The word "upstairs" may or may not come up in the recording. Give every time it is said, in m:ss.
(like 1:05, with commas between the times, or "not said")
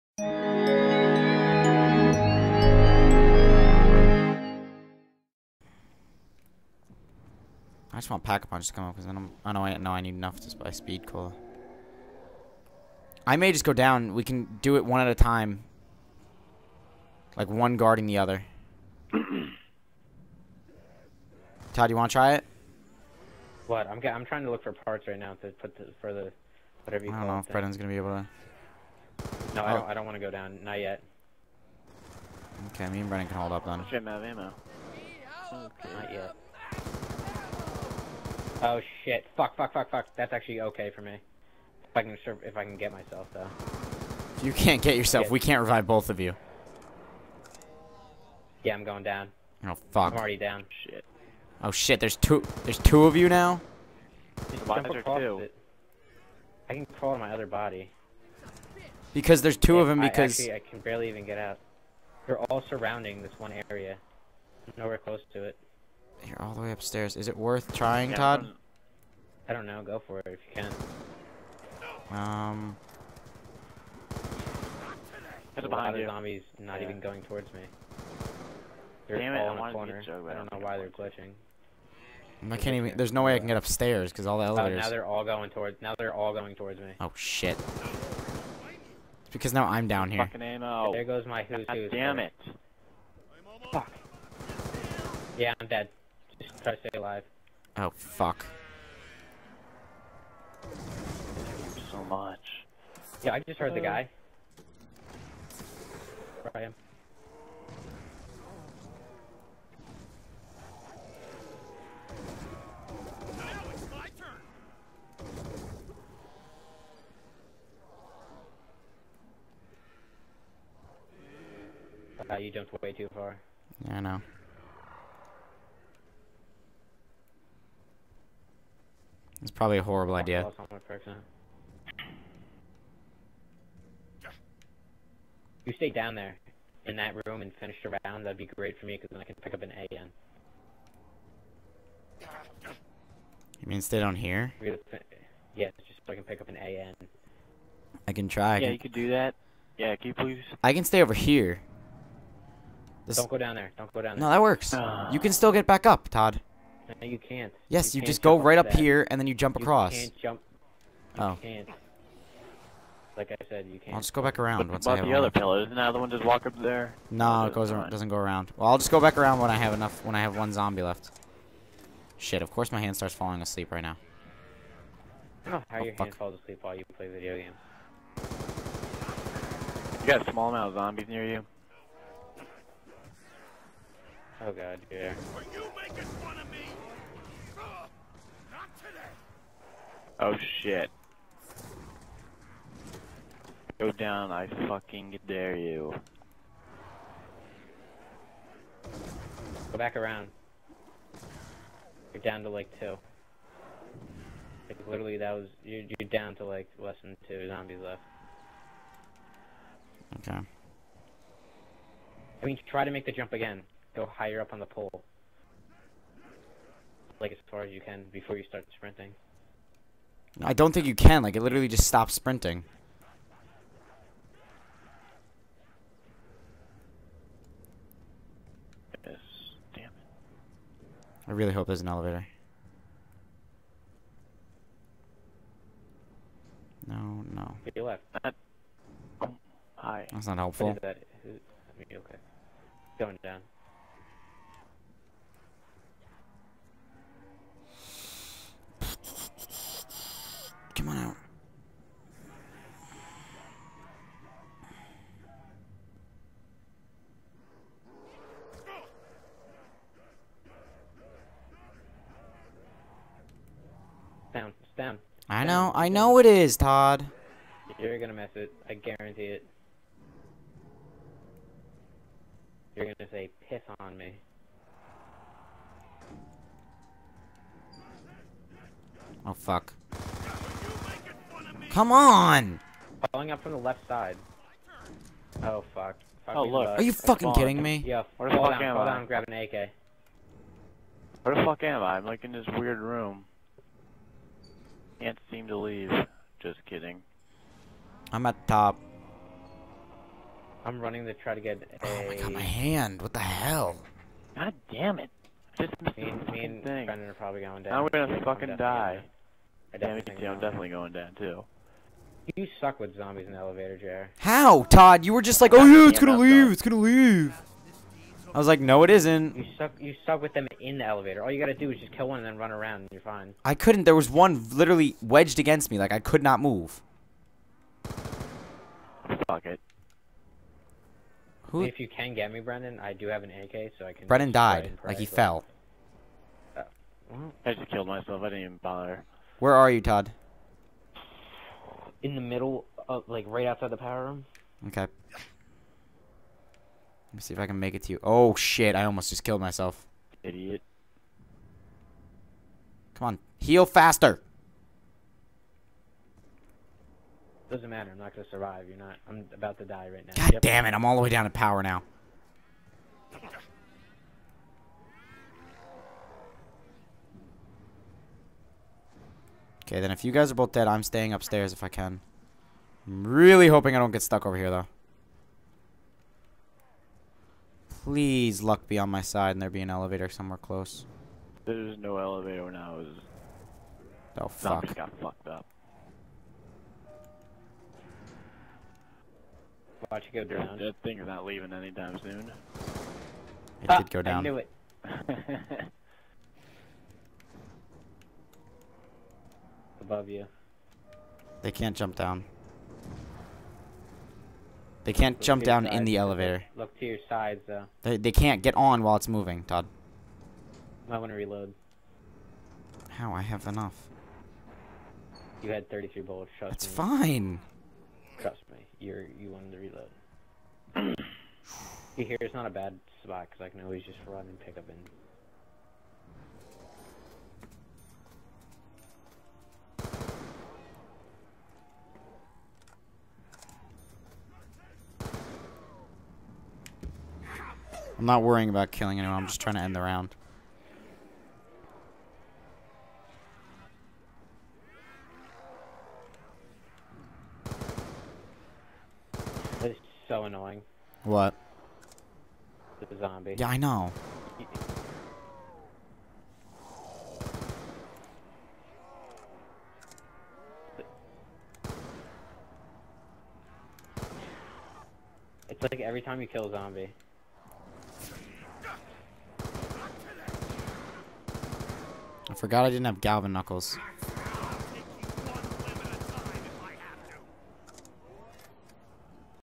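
1:06, 1:23, 6:11.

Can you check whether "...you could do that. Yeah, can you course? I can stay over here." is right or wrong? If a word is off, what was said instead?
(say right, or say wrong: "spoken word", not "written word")
wrong: "please", not "course".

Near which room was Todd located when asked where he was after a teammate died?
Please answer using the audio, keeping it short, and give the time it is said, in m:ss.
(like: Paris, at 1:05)
the power room, at 5:43.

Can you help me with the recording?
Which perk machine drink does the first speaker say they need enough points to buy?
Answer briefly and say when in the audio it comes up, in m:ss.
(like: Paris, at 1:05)
Speed Cola, at 0:10.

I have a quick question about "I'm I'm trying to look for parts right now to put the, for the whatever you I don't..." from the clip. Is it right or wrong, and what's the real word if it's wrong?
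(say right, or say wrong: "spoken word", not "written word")
right.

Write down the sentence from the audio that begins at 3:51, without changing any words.
I really hope there's an elevator.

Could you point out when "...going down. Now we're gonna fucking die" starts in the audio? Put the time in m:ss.
5:07.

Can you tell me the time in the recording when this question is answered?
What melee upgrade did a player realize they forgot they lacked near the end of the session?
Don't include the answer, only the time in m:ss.
7:53.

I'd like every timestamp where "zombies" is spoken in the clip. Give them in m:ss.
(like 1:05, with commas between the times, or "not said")
1:16, 2:50, 3:00, 3:27, 5:12, 6:24, 7:32, 7:46.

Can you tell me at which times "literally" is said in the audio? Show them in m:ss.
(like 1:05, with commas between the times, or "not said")
3:24, 3:41, 5:24.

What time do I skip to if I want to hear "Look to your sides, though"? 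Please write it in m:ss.
6:46.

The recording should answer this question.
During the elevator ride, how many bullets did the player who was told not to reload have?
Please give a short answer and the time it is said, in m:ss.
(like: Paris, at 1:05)
33, at 6:55.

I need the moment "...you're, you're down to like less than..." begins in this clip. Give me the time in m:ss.
3:25.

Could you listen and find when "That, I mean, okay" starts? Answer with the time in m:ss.
4:00.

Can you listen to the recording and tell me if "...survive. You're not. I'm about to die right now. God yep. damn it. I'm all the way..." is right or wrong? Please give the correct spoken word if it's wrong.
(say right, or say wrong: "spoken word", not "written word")
right.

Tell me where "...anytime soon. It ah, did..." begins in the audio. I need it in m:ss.
6:31.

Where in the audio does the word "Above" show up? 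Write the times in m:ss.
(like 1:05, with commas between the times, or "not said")
6:39.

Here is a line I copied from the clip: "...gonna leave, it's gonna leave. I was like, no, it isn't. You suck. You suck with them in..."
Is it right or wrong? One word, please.
right.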